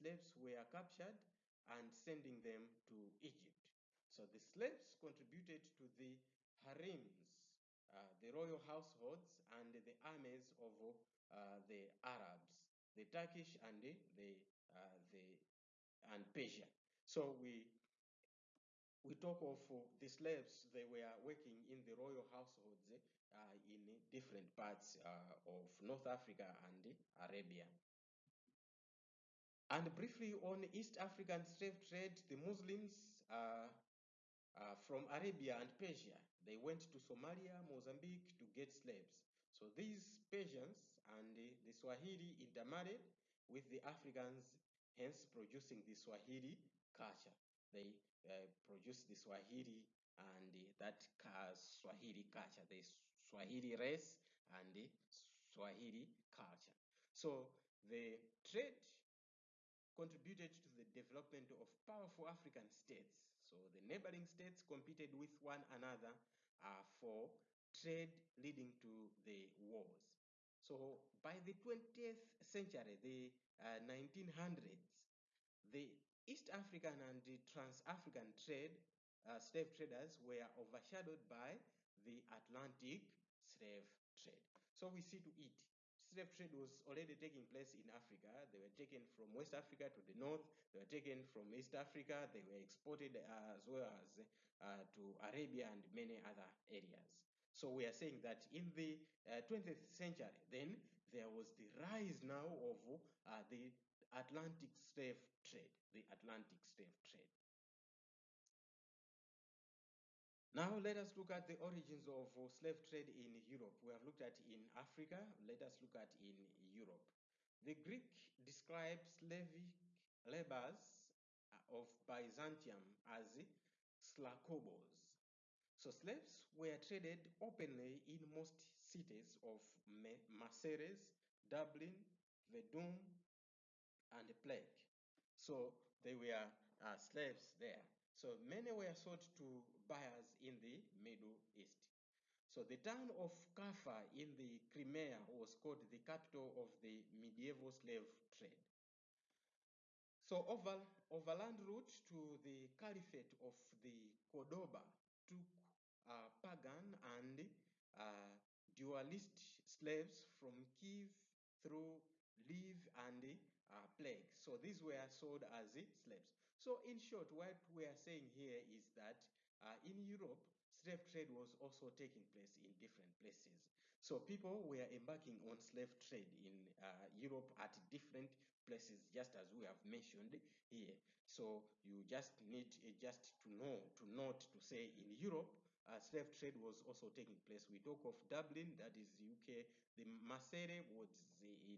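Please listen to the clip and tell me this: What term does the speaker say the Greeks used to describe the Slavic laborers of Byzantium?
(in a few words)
slakobos.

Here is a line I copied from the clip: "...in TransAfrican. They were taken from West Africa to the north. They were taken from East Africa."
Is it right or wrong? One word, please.
wrong.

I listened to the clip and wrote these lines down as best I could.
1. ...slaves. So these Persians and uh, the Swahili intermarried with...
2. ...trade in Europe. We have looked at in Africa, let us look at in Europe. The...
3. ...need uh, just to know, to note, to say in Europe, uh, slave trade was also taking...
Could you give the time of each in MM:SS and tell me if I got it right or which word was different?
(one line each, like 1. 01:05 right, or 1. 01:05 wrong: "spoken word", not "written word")
1. 00:38 right
2. 01:52 right
3. 03:02 right.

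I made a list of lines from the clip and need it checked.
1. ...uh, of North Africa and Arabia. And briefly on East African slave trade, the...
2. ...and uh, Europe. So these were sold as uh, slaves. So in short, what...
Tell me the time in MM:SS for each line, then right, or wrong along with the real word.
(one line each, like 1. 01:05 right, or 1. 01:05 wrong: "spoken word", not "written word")
1. 00:24 right
2. 02:42 wrong: "Prague", not "Europe".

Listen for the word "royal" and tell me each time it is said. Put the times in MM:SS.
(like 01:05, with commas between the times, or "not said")
00:08, 00:21.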